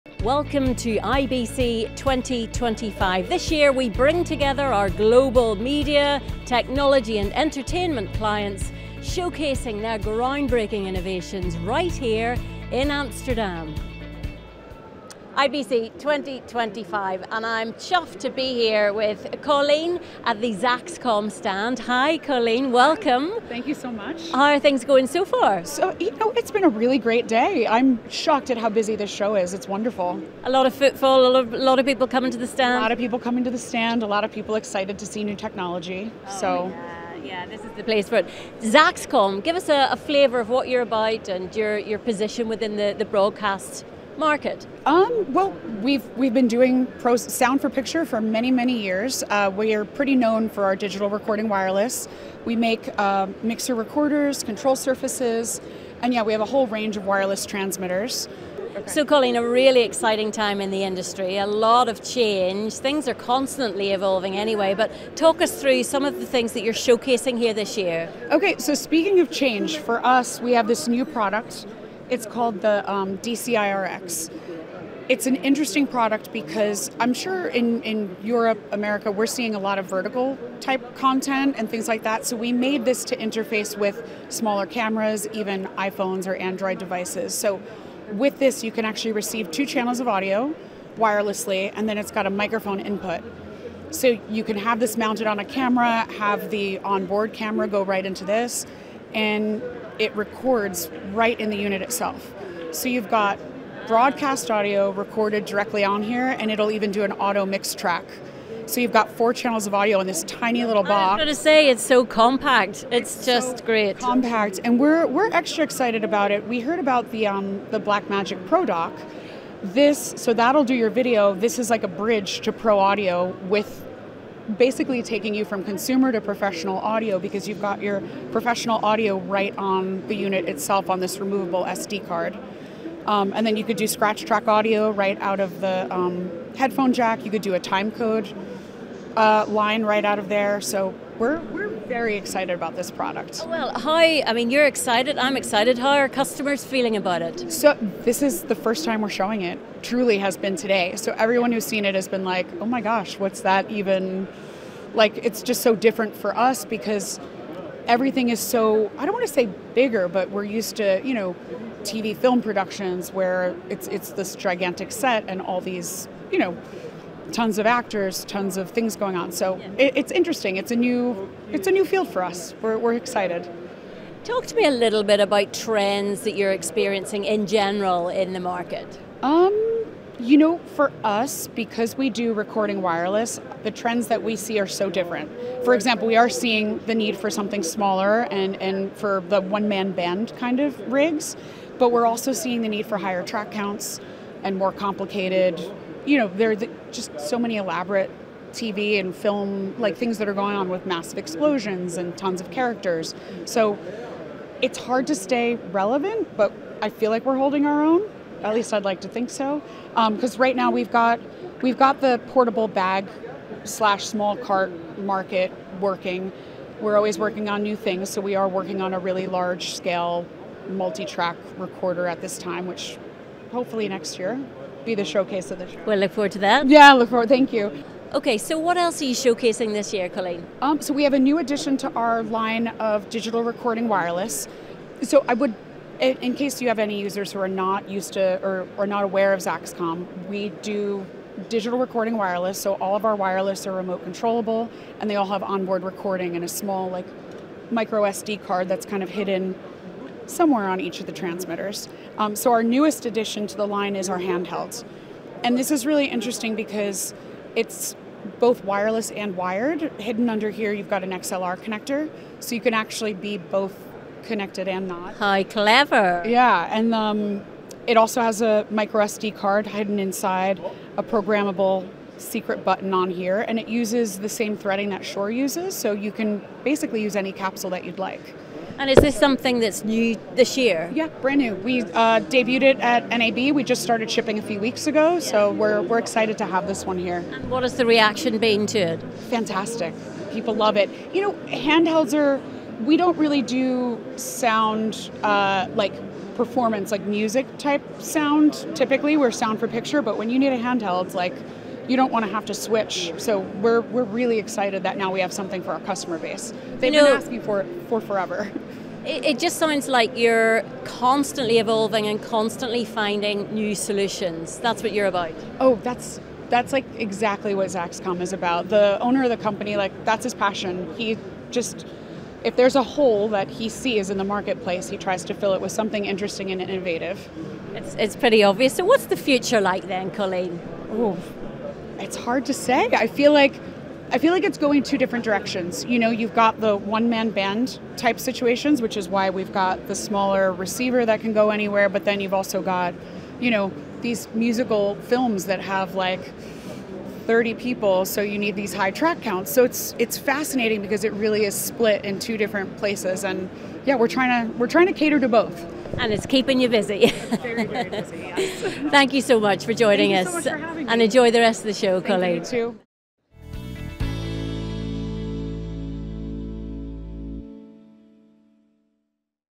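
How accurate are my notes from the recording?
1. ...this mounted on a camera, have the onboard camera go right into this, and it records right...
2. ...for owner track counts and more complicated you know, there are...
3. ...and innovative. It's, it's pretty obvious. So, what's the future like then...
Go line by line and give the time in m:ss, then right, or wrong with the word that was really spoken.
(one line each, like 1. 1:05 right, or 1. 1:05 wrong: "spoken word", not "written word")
1. 1:34 right
2. 3:12 wrong: "higher", not "owner"
3. 5:26 right.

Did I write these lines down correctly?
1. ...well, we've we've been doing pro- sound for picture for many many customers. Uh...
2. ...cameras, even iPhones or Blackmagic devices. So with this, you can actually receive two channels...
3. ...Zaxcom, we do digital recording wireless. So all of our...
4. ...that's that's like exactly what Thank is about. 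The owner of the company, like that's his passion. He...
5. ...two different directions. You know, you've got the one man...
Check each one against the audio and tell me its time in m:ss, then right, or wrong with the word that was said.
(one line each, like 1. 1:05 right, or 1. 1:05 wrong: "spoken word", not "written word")
1. 0:45 wrong: "years", not "customers"
2. 1:24 wrong: "Android", not "Blackmagic"
3. 3:59 right
4. 5:15 wrong: "Zaxcom", not "Thank"
5. 5:34 right.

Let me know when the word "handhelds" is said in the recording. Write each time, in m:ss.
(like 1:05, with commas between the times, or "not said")
4:14, 4:51, 5:00.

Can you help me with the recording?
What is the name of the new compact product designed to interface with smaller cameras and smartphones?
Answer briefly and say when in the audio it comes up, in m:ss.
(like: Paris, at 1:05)
DCiRX, at 1:13.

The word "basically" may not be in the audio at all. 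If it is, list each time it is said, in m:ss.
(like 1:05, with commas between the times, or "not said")
2:04, 4:36.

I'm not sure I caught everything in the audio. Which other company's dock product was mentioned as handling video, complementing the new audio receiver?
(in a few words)
Blackmagic.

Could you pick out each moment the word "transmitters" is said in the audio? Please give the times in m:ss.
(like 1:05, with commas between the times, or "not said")
0:57, 4:11.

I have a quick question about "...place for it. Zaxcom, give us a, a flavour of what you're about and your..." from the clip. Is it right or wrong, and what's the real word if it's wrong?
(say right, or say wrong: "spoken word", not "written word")
right.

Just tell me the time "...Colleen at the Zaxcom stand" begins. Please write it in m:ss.
0:19.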